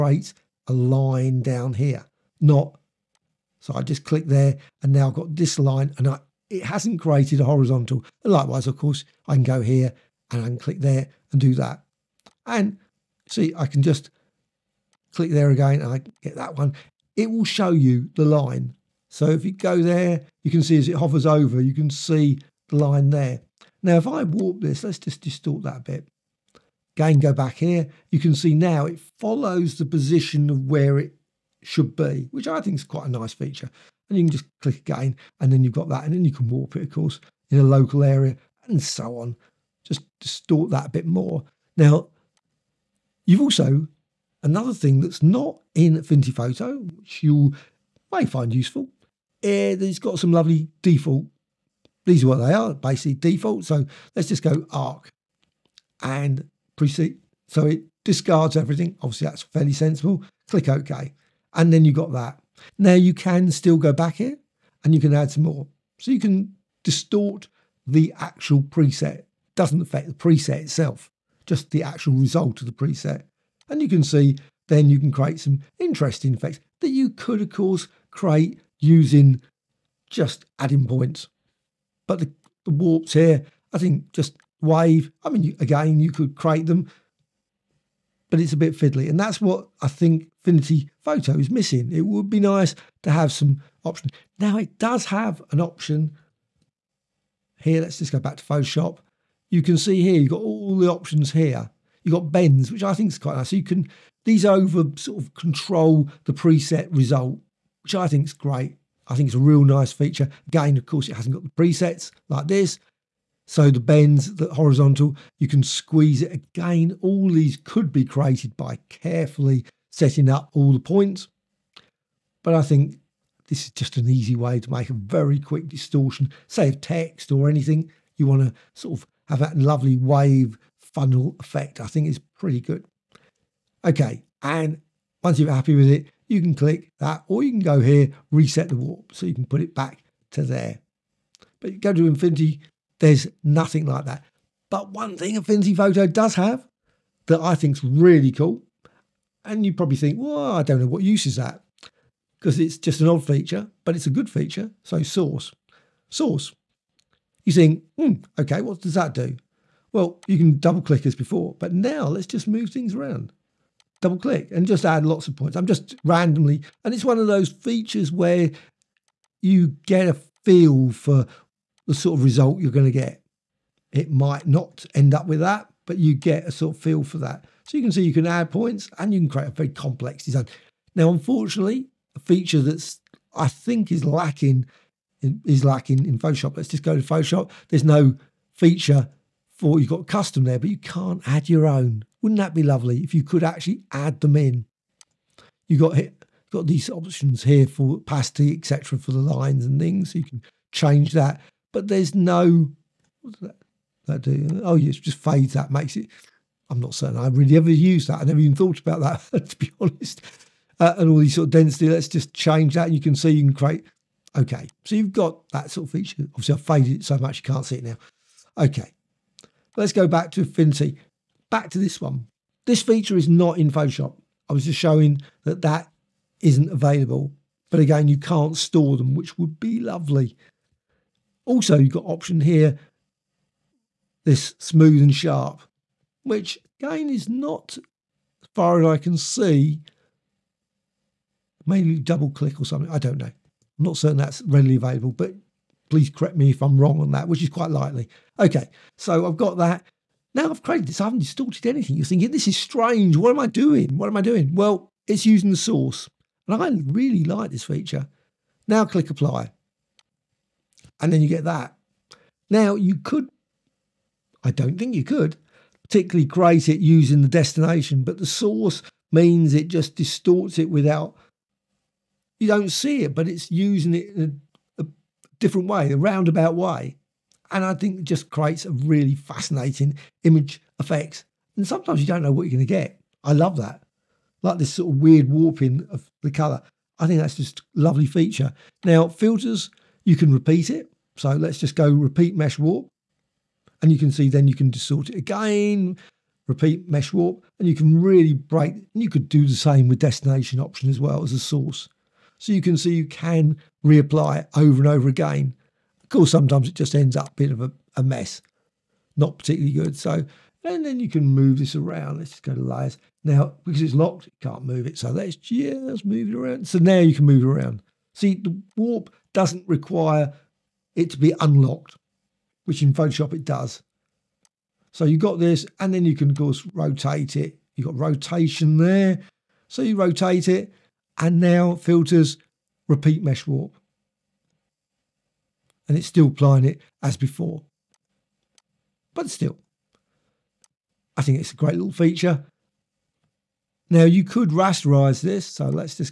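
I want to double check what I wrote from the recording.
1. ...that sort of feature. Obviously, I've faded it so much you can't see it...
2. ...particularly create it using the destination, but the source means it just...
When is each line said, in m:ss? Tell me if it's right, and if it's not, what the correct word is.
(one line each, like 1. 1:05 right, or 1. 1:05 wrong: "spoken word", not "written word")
1. 3:35 right
2. 4:25 right.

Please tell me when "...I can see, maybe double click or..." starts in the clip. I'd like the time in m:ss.
3:58.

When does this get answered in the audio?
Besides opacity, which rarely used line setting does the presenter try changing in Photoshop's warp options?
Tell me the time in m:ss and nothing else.
3:31.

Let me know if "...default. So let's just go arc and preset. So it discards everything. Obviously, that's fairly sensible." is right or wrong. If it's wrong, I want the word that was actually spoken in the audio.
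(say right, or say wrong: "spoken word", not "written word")
right.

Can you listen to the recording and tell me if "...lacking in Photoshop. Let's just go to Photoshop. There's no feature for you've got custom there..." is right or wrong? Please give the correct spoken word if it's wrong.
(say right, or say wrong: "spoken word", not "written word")
right.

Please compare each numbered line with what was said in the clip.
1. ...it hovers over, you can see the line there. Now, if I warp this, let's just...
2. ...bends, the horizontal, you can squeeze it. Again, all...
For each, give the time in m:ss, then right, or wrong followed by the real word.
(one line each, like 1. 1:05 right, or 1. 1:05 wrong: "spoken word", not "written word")
1. 0:20 right
2. 1:53 right.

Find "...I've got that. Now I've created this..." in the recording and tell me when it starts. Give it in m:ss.
4:09.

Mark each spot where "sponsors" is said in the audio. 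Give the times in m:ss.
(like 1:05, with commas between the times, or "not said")
not said.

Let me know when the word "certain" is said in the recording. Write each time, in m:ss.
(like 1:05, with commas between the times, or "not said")
3:26, 4:03.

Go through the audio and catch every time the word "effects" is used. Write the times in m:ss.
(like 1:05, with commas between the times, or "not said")
1:16, 2:11, 4:40.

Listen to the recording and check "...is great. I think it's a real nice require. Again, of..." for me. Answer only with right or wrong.
wrong.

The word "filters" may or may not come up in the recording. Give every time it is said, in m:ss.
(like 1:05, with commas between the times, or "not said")
4:49, 5:31.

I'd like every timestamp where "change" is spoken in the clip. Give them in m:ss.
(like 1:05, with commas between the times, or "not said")
3:20, 3:32.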